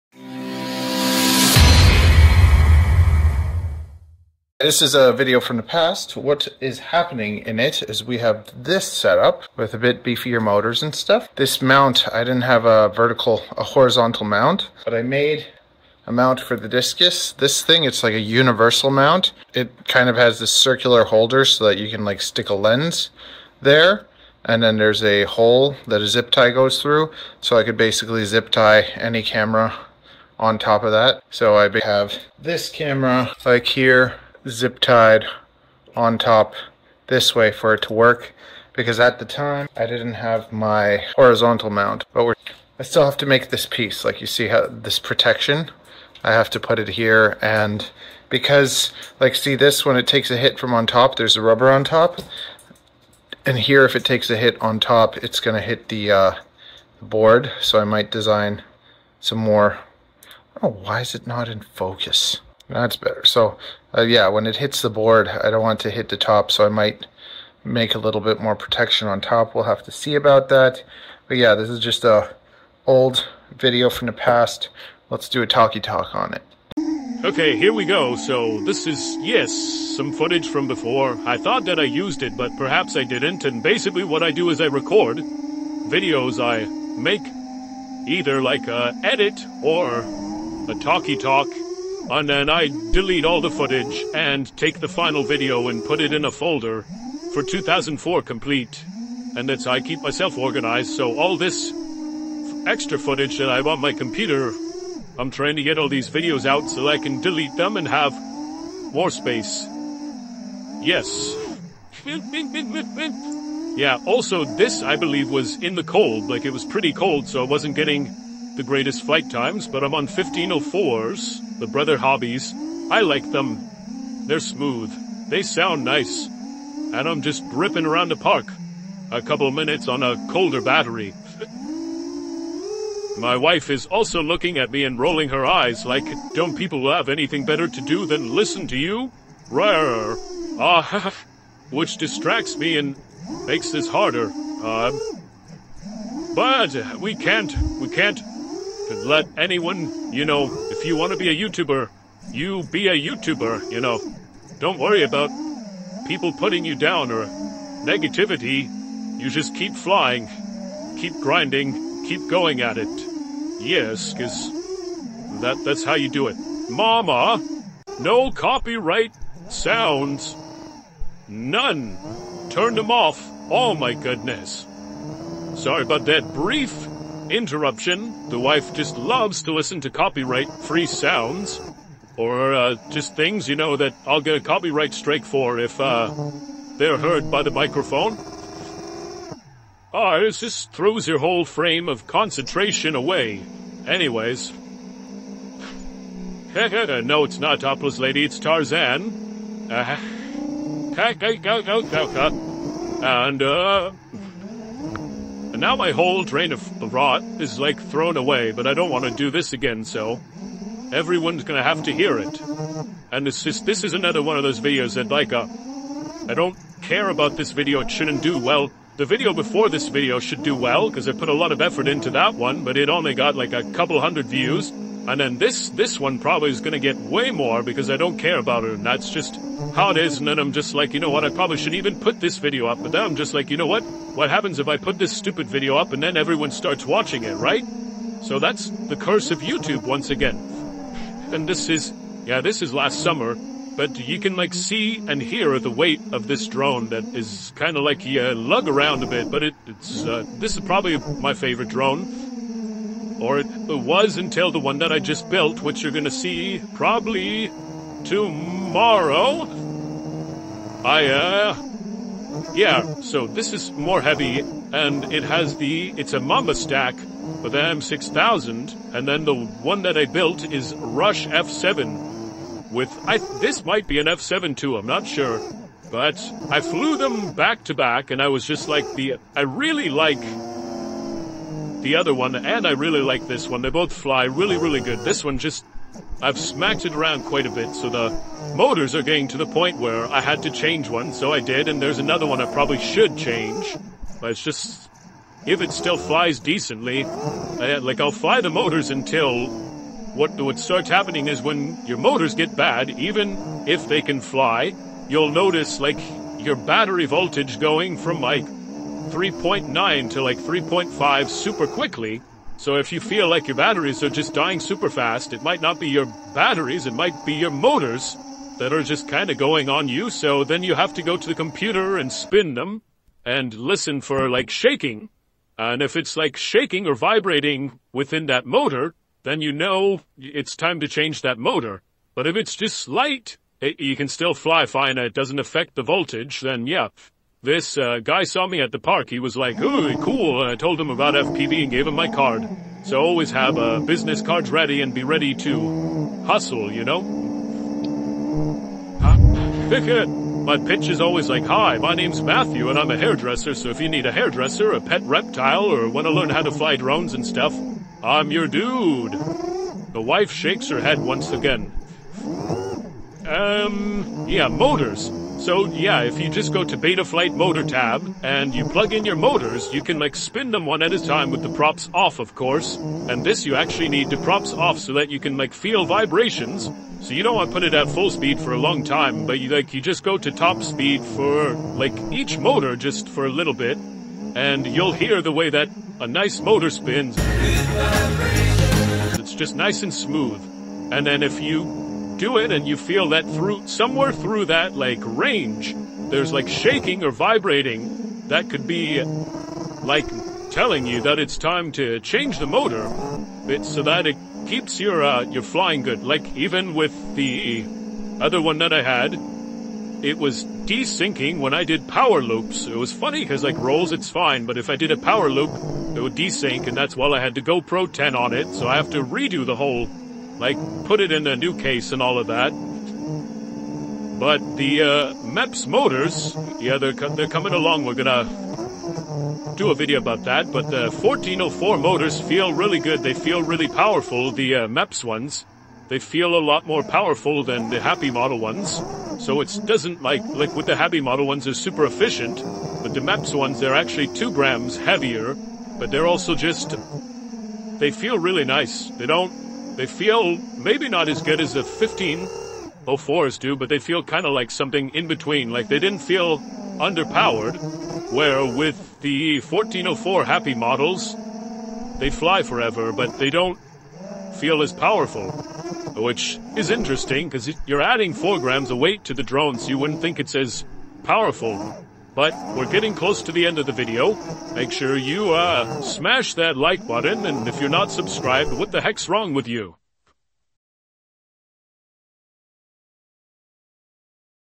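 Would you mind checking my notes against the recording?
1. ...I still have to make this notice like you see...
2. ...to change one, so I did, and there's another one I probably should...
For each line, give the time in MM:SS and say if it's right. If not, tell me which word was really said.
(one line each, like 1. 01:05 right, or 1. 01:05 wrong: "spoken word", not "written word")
1. 00:42 wrong: "piece", not "notice"
2. 04:50 right.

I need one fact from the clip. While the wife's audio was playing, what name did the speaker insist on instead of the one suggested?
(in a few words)
Tarzan.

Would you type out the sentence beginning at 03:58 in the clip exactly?
So that's the curse of YouTube once again.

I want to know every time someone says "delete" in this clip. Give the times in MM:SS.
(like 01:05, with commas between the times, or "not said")
01:32, 01:47.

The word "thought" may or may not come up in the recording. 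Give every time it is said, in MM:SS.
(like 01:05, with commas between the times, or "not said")
01:21, 03:26.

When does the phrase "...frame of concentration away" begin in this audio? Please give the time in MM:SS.
03:11.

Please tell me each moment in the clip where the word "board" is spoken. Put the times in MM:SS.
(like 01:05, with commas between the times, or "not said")
00:57, 01:04.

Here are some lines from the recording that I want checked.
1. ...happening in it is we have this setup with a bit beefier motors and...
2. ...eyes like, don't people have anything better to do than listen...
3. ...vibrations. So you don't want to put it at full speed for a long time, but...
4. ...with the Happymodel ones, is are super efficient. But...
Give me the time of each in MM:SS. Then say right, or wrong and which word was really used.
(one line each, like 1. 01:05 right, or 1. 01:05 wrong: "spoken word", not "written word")
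1. 00:06 right
2. 02:15 right
3. 06:15 right
4. 07:20 right.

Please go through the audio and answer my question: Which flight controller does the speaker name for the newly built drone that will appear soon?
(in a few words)
Rush F7.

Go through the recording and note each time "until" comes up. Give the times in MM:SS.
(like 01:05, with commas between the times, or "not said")
04:14, 04:58.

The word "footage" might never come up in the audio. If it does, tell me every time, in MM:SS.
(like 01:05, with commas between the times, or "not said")
01:20, 01:33, 01:42.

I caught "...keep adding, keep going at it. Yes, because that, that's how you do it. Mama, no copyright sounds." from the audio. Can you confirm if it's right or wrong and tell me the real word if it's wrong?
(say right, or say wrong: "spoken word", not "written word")
wrong: "grinding", not "adding".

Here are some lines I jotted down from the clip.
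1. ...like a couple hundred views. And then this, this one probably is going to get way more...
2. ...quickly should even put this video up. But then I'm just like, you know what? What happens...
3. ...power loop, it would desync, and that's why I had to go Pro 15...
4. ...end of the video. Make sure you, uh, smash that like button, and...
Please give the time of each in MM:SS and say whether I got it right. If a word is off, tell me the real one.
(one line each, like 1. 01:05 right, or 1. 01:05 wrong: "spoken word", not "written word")
1. 03:43 right
2. 03:51 wrong: "probably", not "quickly"
3. 06:54 wrong: "10", not "15"
4. 07:53 right.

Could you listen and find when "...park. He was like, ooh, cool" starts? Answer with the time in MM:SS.
05:38.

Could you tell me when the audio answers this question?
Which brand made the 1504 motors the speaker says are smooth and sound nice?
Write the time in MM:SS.
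02:01.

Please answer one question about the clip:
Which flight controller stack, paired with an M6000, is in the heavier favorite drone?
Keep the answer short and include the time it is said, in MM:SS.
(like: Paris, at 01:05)
Mamba, at 04:26.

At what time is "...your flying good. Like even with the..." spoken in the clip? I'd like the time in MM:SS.
06:45.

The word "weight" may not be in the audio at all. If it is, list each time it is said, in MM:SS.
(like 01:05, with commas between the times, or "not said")
04:05, 07:48.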